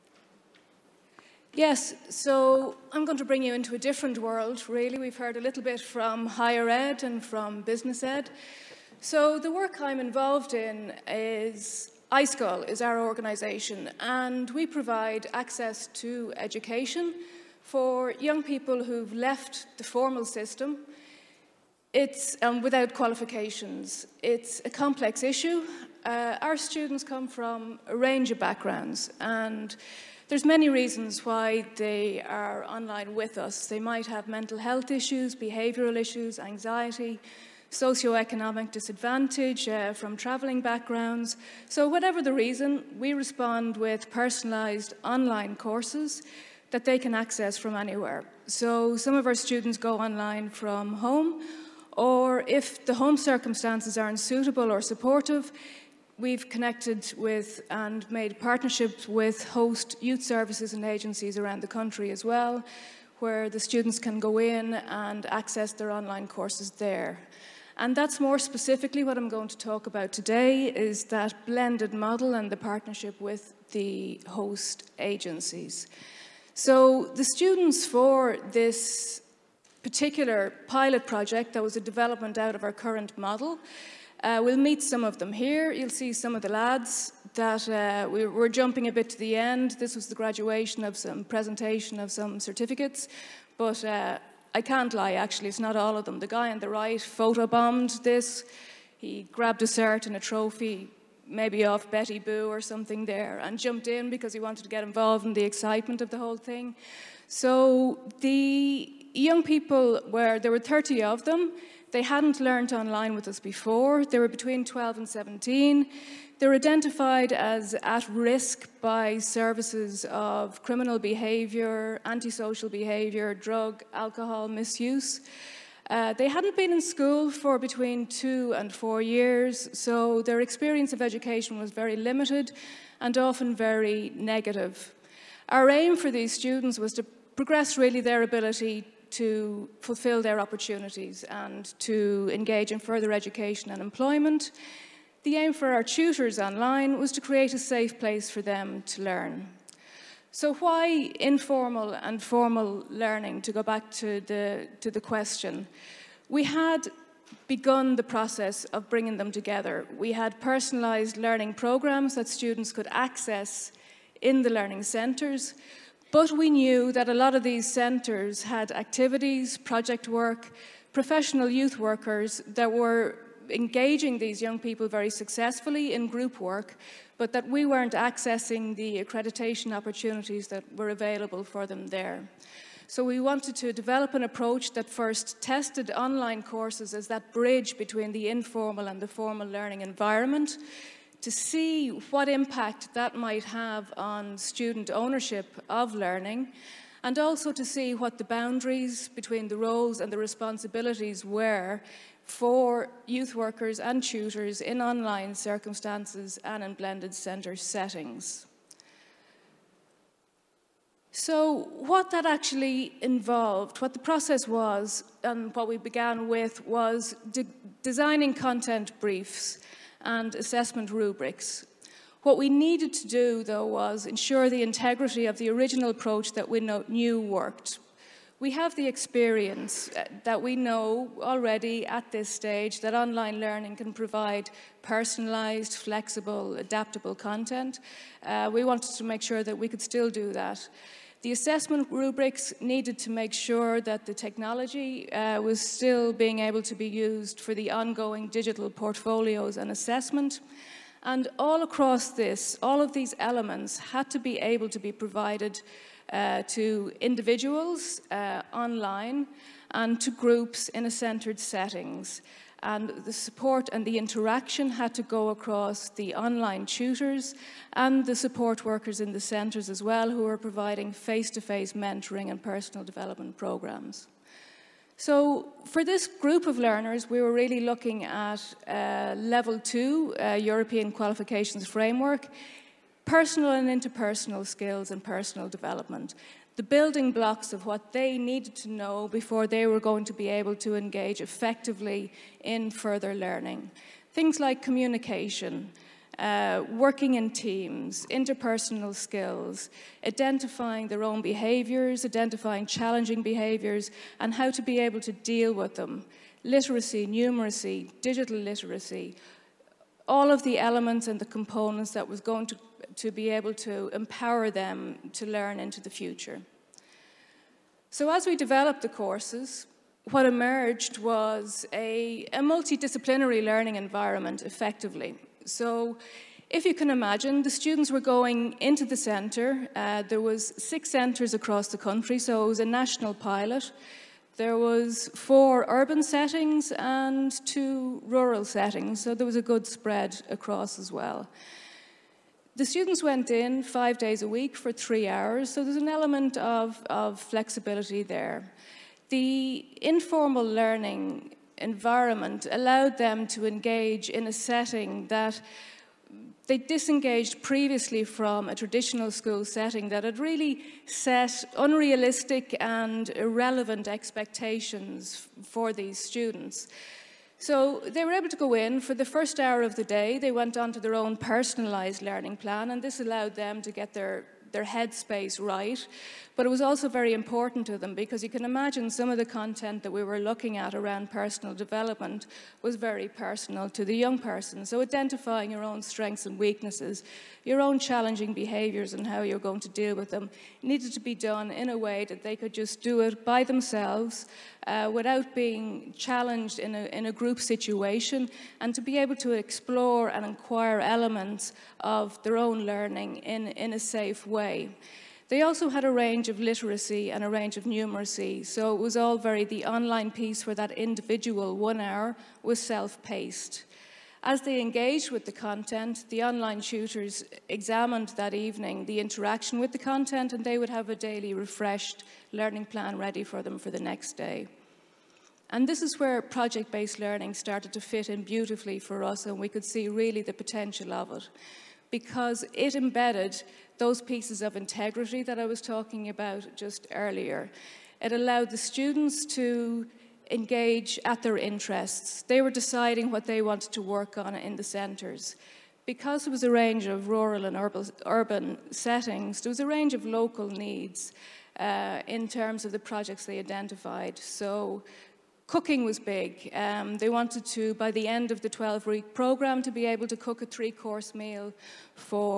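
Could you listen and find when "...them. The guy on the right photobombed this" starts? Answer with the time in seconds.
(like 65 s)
96 s.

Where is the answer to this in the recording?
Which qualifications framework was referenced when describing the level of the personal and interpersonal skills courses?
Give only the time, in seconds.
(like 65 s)
280 s.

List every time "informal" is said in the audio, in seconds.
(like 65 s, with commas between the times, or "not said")
151 s, 188 s, 349 s.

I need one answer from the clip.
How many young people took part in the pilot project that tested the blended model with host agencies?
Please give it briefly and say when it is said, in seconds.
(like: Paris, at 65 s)
30, at 110 s.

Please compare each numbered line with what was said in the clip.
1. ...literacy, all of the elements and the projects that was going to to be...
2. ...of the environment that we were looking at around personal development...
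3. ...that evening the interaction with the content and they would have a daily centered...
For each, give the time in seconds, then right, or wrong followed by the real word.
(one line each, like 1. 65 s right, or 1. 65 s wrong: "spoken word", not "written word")
1. 308 s wrong: "components", not "projects"
2. 379 s wrong: "content", not "environment"
3. 418 s wrong: "refreshed", not "centered".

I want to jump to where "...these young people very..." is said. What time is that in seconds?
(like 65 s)
174 s.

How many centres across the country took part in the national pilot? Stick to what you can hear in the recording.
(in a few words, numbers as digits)
6.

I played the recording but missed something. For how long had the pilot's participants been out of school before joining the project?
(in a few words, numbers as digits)
2 to 4 years.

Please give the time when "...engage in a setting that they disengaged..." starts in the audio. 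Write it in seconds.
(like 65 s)
353 s.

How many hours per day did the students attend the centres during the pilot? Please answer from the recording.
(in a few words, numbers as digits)
3.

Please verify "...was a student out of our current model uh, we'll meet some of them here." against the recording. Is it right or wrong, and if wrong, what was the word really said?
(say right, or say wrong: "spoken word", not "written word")
wrong: "development", not "student".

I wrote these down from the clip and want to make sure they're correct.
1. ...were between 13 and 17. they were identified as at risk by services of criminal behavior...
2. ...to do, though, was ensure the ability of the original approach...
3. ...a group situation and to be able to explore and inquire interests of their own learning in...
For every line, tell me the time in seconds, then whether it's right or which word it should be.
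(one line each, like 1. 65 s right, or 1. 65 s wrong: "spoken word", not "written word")
1. 114 s wrong: "12", not "13"
2. 222 s wrong: "integrity", not "ability"
3. 397 s wrong: "elements", not "interests".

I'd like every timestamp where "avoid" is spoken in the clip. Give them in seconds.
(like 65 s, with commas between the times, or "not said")
not said.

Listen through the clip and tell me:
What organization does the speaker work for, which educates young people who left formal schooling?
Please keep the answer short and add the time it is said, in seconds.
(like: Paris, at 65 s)
iScoil, at 12 s.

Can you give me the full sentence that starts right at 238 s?
Uh, we wanted to make sure that we could still do that.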